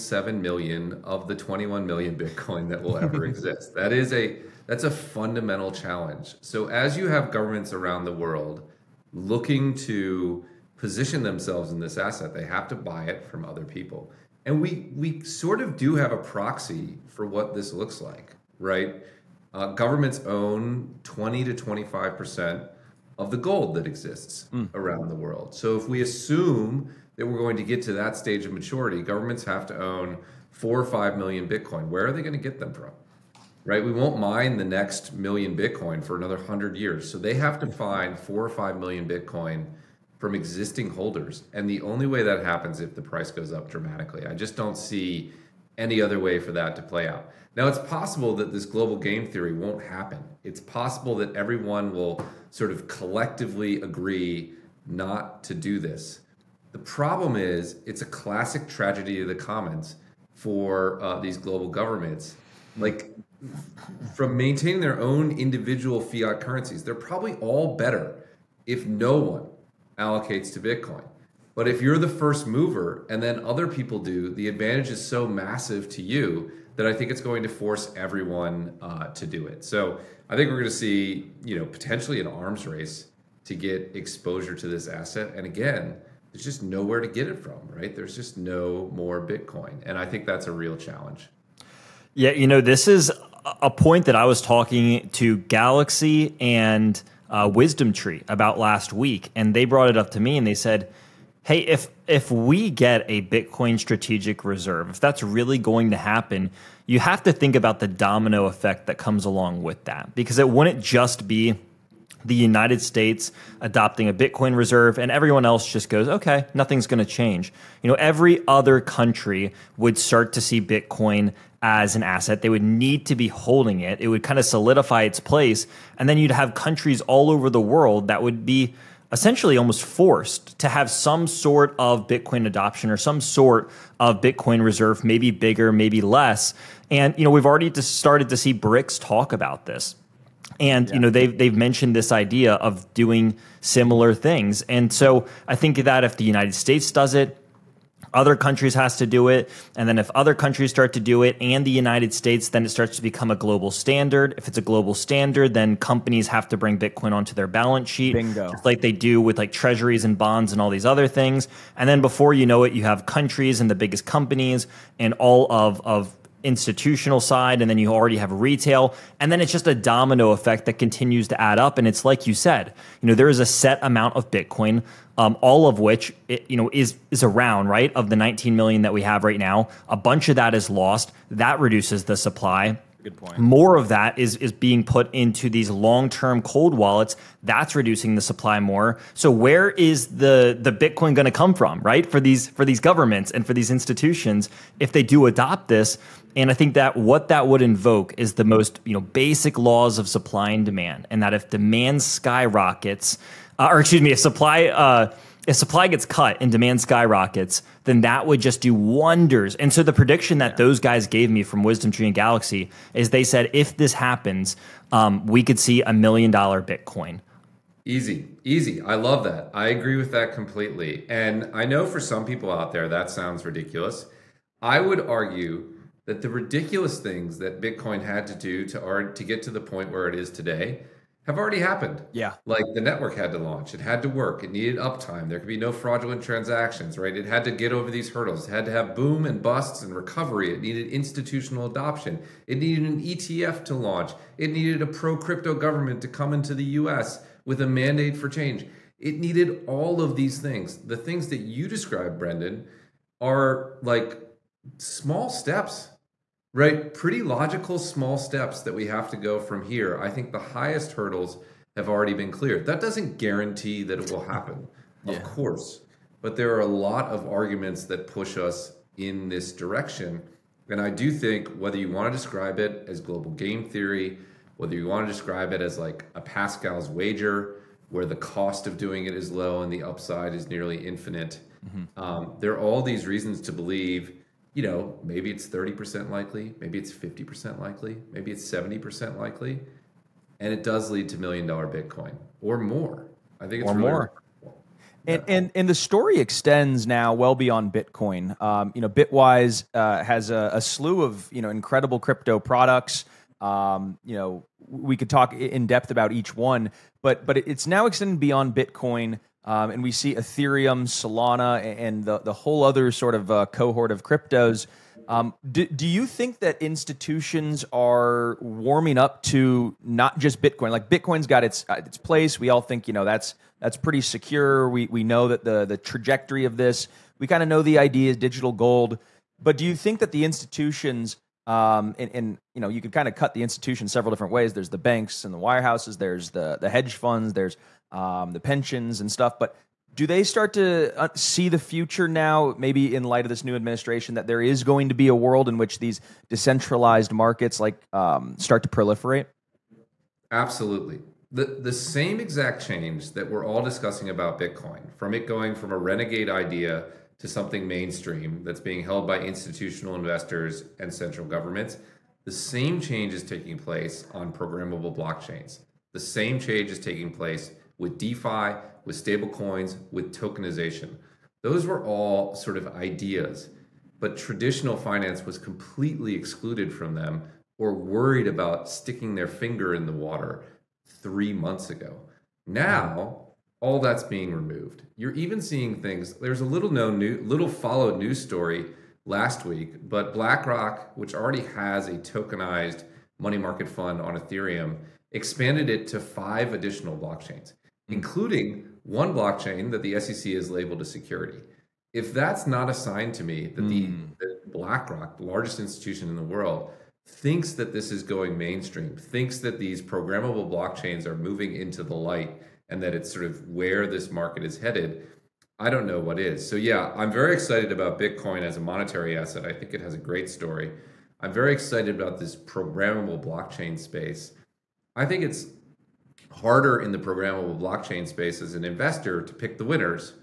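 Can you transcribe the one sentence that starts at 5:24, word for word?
We we know that the the trajectory of this.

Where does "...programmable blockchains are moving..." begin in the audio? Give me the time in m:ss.
6:49.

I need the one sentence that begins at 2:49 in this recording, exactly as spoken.
And then it's just a domino effect that continues to add up.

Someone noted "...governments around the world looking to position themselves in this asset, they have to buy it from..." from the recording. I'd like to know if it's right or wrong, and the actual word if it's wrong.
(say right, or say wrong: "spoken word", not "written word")
right.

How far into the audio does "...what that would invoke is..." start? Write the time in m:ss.
3:16.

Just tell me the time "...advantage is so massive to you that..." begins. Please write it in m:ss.
1:14.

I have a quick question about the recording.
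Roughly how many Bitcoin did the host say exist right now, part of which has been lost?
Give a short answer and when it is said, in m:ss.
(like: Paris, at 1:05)
19 million, at 2:58.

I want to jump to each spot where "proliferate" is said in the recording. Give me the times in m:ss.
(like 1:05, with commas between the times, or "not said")
5:48.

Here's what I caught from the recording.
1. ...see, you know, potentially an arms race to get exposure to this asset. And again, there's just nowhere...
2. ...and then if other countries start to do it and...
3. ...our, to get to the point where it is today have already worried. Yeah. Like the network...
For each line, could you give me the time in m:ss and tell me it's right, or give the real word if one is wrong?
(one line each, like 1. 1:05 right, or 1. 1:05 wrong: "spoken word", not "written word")
1. 1:20 right
2. 2:29 right
3. 3:48 wrong: "happened", not "worried".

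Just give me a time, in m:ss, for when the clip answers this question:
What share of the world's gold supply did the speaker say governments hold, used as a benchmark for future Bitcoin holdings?
0:21.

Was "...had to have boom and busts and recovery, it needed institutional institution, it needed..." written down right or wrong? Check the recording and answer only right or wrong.
wrong.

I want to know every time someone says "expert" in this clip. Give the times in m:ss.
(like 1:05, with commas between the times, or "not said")
not said.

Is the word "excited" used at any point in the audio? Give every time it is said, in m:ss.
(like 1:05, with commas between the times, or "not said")
6:57, 7:01.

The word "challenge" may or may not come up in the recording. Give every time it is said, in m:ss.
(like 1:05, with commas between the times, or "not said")
0:05, 1:30.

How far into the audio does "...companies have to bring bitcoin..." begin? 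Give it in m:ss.
2:35.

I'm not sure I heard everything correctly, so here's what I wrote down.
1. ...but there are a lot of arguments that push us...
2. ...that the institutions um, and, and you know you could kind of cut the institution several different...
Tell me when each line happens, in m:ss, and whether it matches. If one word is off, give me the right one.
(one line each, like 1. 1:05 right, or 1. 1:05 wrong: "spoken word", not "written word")
1. 4:26 right
2. 5:30 right.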